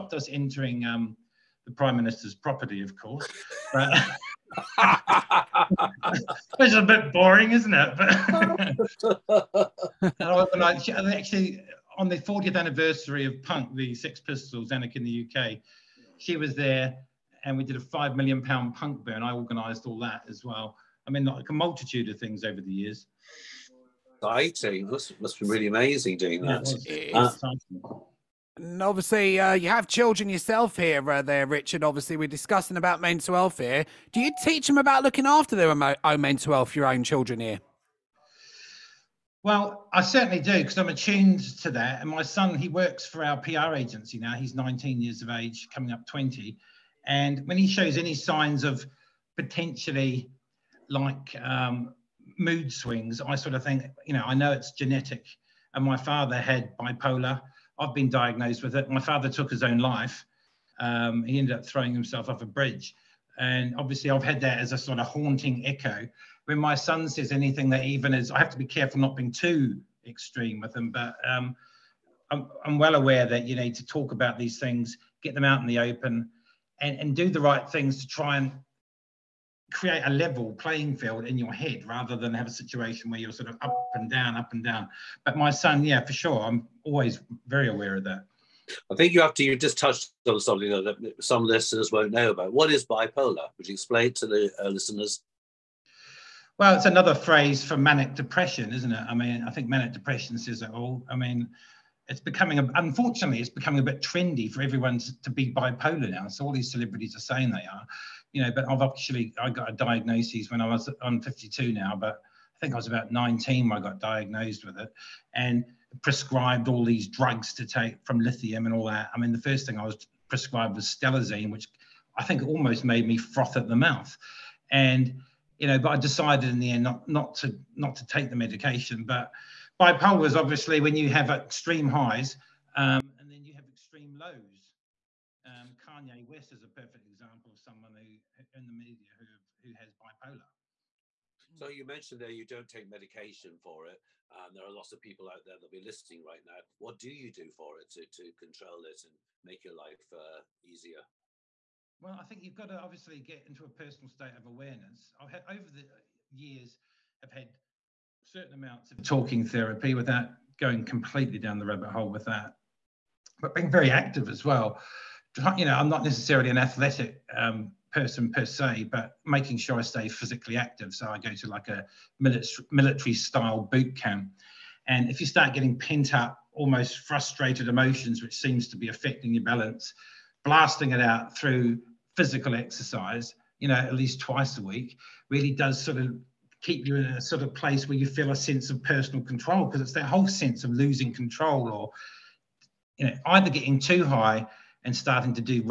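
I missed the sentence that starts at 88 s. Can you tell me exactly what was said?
I think you have to, you just touched on something that some listeners won't know about.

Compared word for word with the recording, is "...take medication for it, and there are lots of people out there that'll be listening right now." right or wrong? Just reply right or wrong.
right.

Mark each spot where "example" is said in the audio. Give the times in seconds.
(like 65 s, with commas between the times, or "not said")
137 s.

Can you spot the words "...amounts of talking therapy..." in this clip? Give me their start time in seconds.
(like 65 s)
158 s.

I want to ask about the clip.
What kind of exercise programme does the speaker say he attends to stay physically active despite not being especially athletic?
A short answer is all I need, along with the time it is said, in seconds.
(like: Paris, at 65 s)
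military style boot camp, at 172 s.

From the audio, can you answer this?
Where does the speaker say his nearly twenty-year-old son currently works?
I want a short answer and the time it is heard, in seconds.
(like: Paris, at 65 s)
PR agency, at 43 s.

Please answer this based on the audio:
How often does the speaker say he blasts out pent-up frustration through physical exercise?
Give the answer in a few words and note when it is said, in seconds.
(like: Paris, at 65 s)
twice a week, at 184 s.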